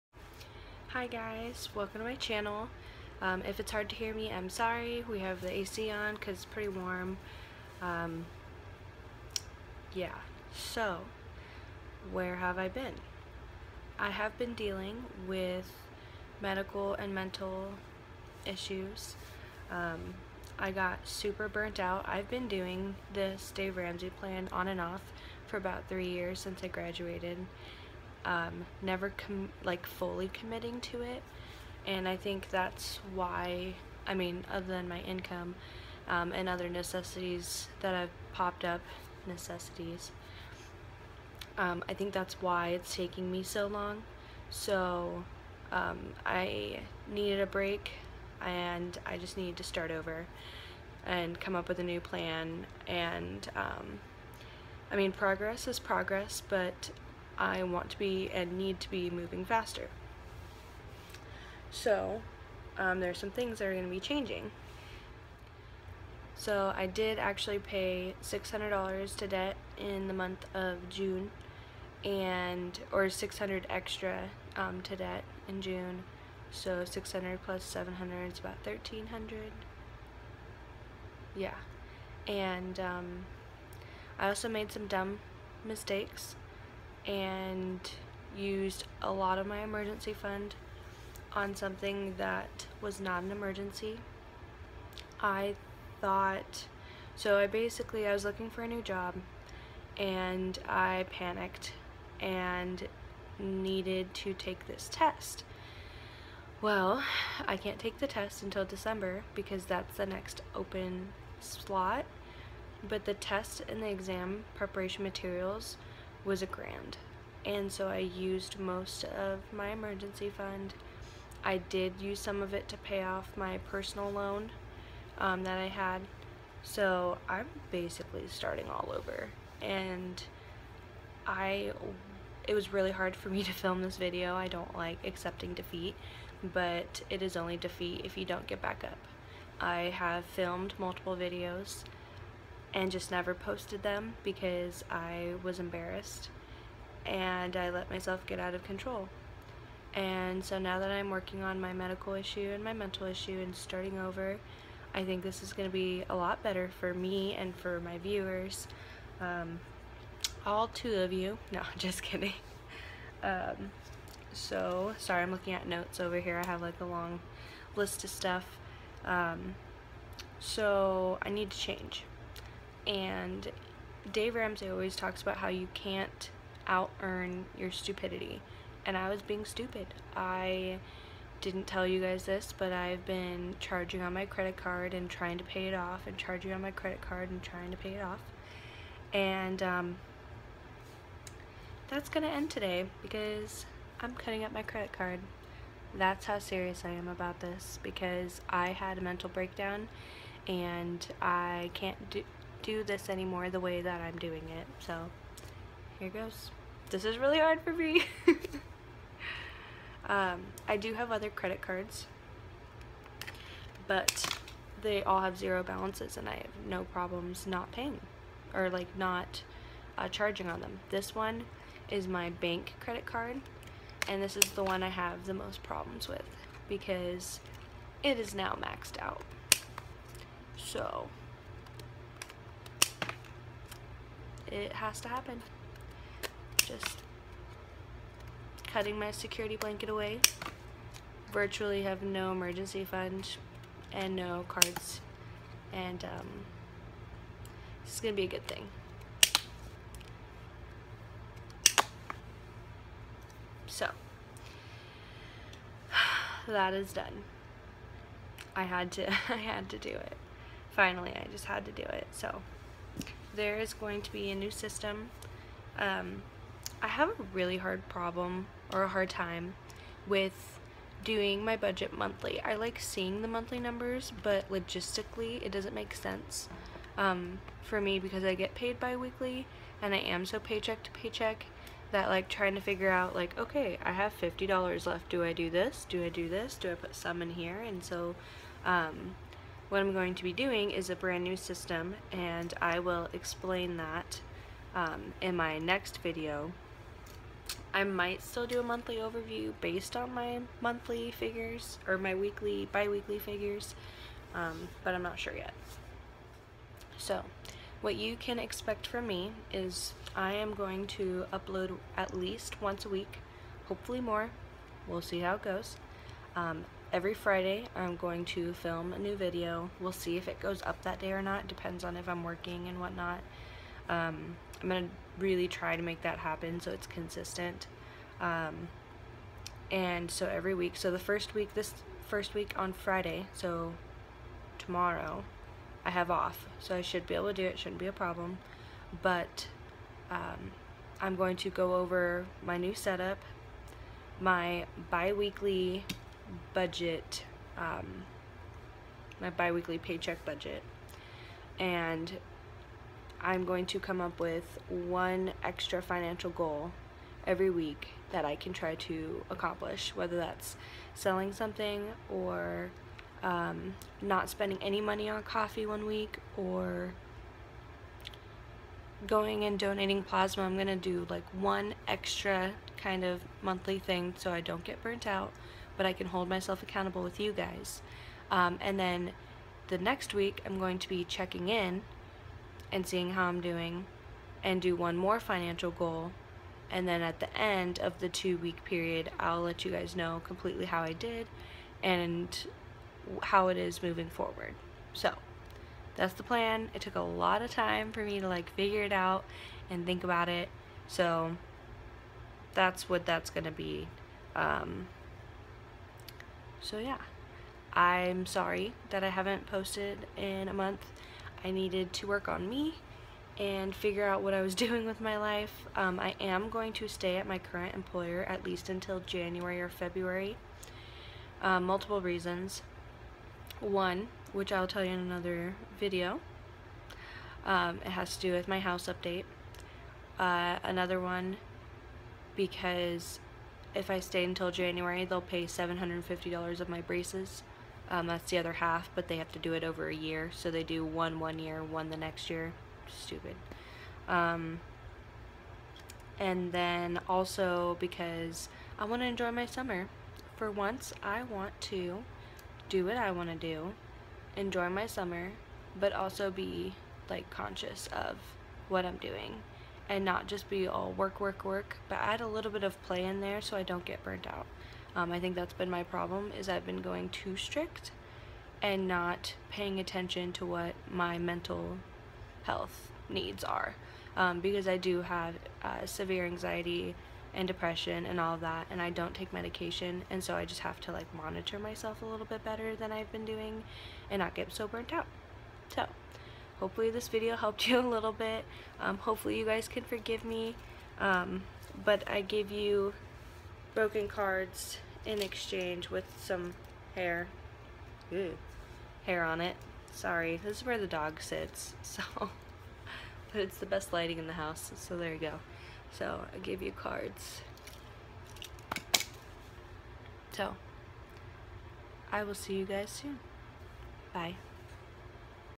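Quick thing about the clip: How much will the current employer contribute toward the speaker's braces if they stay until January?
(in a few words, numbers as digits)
$750.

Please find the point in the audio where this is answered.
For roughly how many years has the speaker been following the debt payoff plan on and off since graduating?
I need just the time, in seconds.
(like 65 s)
25 s.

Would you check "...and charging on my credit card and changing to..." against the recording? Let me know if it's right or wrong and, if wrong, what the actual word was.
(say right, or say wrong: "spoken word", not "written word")
wrong: "trying", not "changing".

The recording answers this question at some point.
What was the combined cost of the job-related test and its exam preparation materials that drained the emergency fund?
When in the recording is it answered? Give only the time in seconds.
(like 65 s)
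116 s.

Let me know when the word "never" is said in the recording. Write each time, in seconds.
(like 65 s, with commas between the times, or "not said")
28 s, 143 s.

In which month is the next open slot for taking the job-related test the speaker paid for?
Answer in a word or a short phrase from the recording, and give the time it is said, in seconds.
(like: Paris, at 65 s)
December, at 108 s.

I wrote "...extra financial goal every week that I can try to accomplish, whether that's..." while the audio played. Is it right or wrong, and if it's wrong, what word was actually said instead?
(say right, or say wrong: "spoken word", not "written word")
right.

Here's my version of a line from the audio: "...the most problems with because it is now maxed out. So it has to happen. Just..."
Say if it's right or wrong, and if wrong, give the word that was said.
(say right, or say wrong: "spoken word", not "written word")
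right.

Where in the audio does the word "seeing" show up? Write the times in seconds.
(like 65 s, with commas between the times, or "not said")
272 s, 382 s.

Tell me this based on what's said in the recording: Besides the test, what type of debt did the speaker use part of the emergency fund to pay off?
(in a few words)
personal loan.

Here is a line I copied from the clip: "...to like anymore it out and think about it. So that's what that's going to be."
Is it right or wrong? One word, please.
wrong.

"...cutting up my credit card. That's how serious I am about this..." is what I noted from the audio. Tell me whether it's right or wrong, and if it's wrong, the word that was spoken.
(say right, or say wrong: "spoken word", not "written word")
right.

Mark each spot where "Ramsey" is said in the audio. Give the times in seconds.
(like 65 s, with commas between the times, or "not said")
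23 s, 174 s.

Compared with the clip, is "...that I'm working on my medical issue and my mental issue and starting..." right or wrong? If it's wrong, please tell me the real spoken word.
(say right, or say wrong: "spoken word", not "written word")
right.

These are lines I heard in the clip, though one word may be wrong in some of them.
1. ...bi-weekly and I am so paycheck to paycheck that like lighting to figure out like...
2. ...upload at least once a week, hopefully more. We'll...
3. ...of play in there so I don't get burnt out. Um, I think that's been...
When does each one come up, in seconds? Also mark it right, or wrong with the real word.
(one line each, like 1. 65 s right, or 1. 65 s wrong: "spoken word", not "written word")
1. 278 s wrong: "trying", not "lighting"
2. 311 s right
3. 462 s right.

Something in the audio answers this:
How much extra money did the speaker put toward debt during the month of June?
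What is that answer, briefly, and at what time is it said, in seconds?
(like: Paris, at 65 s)
$600, at 73 s.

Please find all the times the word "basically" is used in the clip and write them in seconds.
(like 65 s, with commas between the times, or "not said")
97 s, 127 s.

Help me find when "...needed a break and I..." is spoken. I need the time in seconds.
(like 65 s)
47 s.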